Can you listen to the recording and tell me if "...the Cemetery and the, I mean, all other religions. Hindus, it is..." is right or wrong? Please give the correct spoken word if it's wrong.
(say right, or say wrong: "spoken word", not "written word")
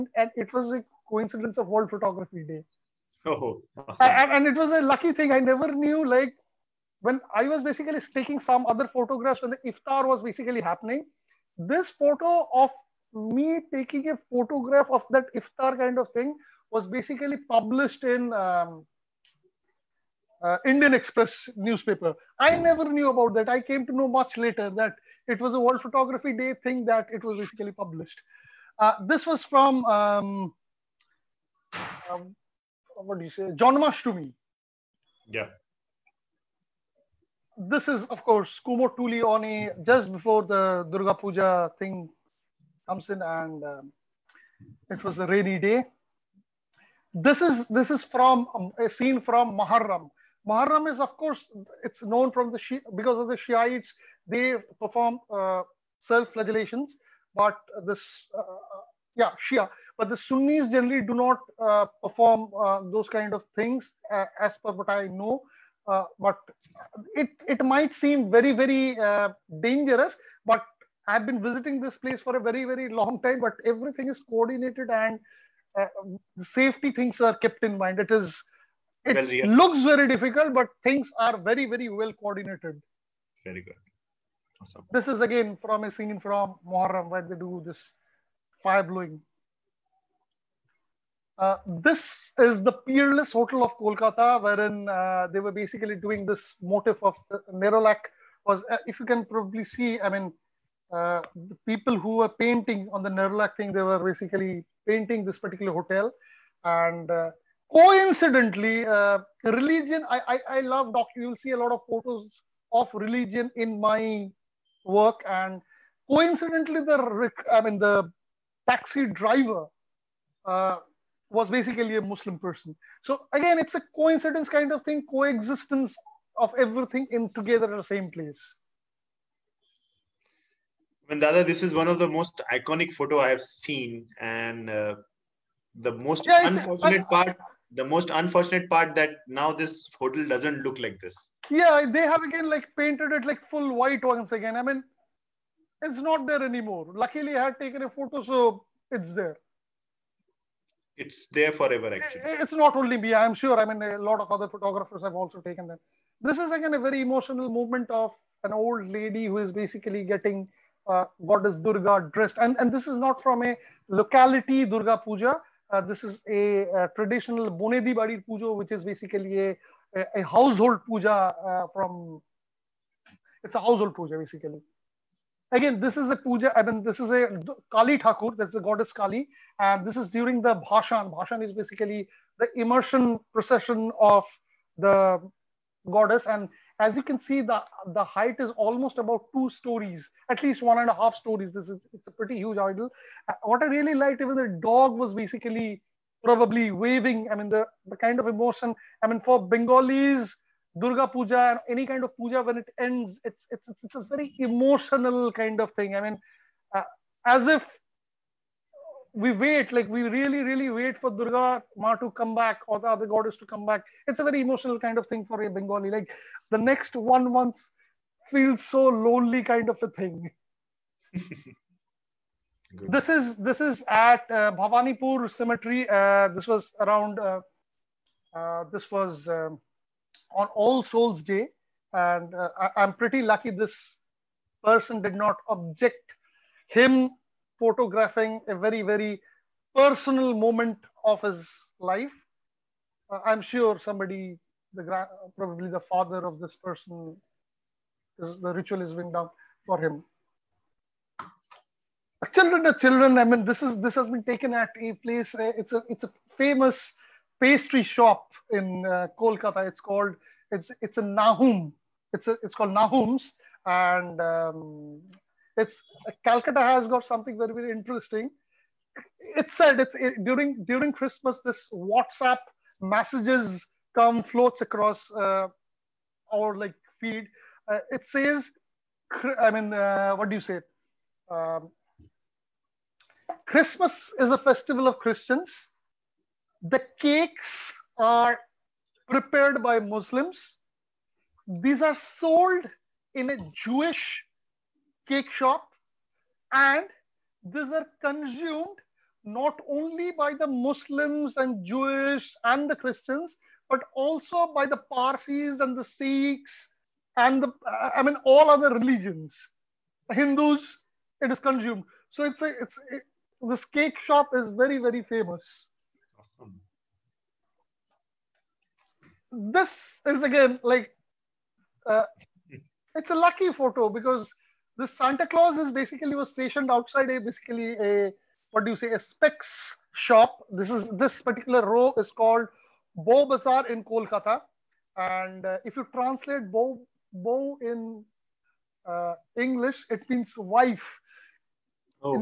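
wrong: "Sikhs", not "Cemetery".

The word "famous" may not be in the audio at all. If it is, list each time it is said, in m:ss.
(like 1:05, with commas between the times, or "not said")
4:16, 5:15.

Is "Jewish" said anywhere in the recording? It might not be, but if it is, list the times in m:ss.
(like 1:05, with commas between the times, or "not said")
4:53, 5:01.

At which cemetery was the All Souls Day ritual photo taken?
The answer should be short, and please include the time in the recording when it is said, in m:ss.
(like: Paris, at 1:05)
Bhavanipur Cemetery, at 3:44.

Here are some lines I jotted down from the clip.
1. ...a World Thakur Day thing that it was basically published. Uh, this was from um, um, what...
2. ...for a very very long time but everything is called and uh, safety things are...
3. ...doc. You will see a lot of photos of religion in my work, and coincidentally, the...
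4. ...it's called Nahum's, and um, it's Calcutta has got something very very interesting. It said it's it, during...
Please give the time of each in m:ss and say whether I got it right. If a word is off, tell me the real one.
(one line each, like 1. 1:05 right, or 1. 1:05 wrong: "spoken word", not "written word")
1. 0:25 wrong: "Photography", not "Thakur"
2. 1:12 wrong: "coordinated", not "called"
3. 1:50 right
4. 4:22 right.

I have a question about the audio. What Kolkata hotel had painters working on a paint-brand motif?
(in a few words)
Peerless Hotel.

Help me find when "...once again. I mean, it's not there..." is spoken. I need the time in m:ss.
2:24.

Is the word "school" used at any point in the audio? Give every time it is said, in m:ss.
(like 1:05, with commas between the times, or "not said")
not said.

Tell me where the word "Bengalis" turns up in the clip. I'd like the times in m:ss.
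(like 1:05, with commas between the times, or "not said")
3:19, 3:35.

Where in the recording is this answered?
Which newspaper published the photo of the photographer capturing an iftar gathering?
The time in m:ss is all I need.
0:20.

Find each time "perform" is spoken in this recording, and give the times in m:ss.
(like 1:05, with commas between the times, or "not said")
0:54, 1:02.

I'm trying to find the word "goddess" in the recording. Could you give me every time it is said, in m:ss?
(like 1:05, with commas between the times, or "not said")
2:41, 2:58, 3:05, 3:33.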